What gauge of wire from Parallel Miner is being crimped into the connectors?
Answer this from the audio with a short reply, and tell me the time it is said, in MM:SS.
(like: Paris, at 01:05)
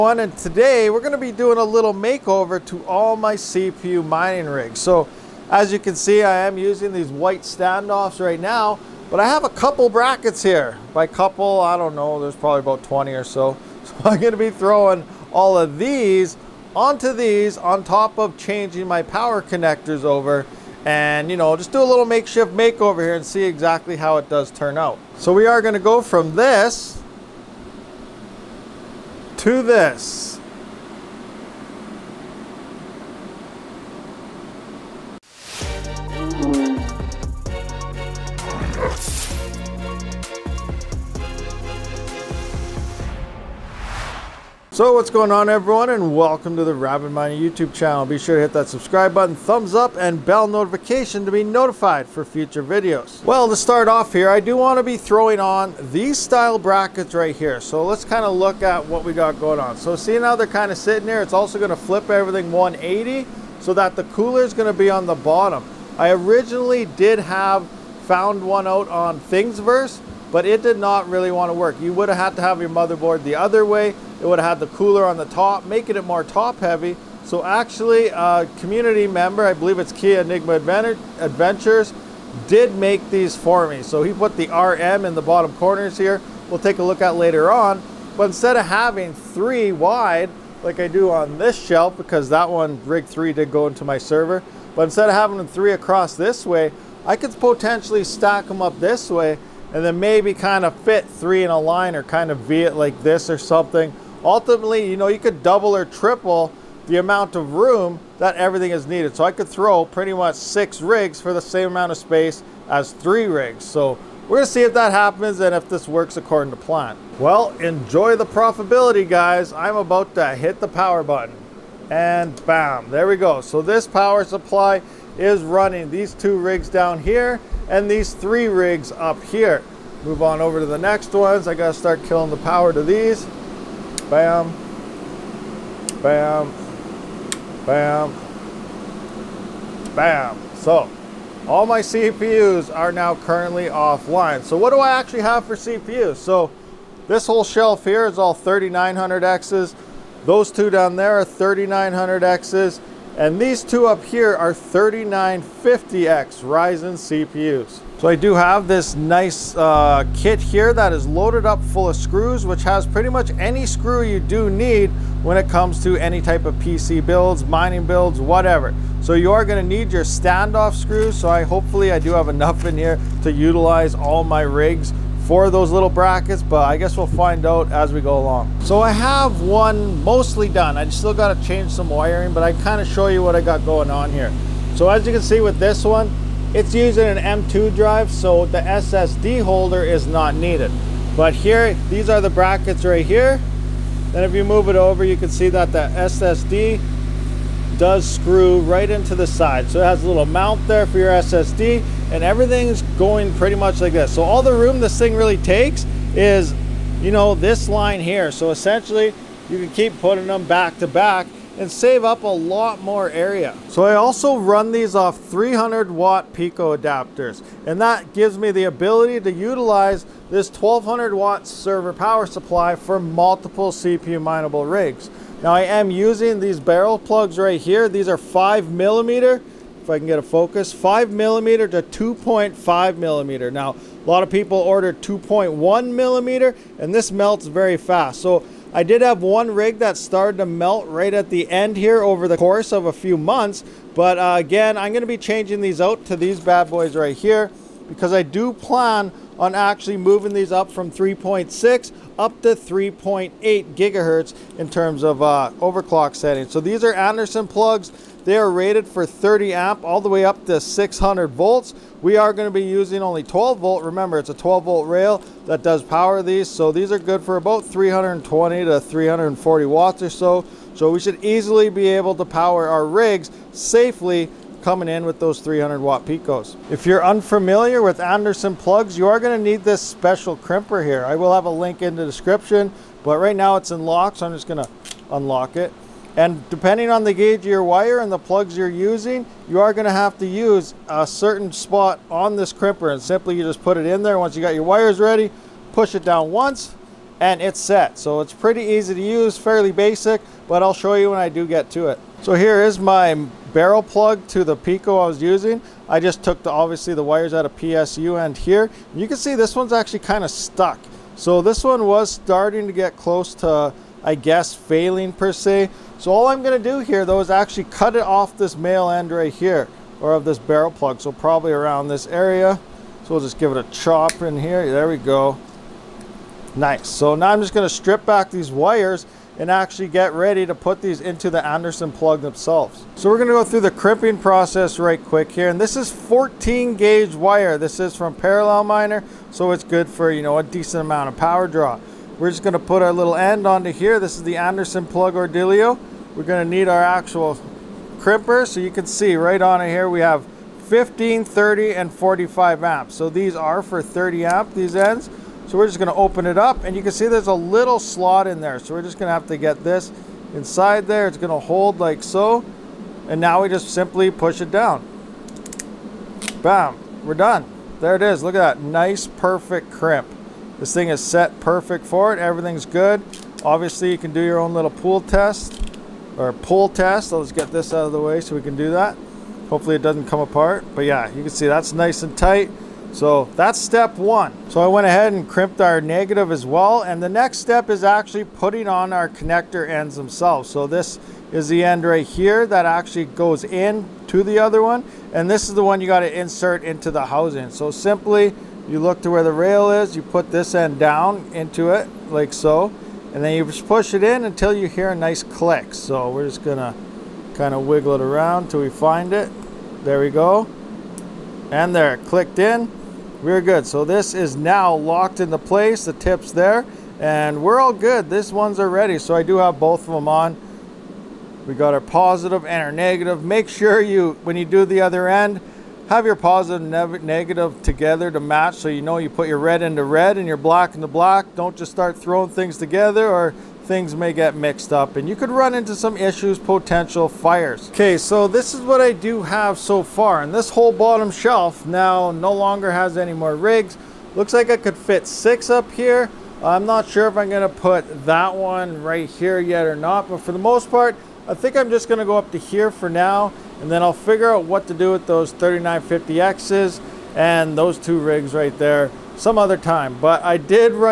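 14 gauge, at 05:35.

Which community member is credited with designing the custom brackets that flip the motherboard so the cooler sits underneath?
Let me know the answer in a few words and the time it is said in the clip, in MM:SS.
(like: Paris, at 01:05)
Kia Enigma Adventures, at 01:19.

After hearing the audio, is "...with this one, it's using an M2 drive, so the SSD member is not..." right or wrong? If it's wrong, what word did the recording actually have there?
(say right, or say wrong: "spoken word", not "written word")
wrong: "holder", not "member".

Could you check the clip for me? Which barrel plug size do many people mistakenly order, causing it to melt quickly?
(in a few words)
2.1 millimeter.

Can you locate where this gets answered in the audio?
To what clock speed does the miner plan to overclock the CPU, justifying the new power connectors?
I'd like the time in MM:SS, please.
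04:12.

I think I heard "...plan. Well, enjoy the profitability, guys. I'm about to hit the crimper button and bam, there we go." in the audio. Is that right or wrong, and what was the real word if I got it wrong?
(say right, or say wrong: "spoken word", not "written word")
wrong: "power", not "crimper".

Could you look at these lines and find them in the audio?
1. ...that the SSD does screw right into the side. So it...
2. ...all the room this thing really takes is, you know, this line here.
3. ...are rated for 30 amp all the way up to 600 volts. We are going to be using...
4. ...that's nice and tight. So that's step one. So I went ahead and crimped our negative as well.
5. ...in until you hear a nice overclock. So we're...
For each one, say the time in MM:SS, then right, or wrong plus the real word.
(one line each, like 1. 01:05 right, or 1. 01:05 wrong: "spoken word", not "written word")
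1. 03:15 right
2. 03:24 right
3. 04:18 right
4. 06:21 right
5. 06:44 wrong: "click", not "overclock".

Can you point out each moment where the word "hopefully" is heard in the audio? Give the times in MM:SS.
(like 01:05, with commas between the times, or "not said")
02:51, 06:19.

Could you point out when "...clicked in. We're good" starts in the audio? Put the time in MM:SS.
06:51.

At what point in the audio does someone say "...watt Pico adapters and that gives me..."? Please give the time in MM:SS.
03:35.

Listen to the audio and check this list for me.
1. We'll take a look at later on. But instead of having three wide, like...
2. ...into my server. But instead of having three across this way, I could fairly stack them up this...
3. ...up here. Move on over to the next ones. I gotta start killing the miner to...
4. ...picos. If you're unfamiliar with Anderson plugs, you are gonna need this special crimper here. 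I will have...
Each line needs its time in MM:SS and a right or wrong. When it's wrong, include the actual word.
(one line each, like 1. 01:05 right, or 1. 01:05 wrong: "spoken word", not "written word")
1. 01:26 right
2. 01:33 wrong: "potentially", not "fairly"
3. 02:08 wrong: "power", not "miner"
4. 04:36 right.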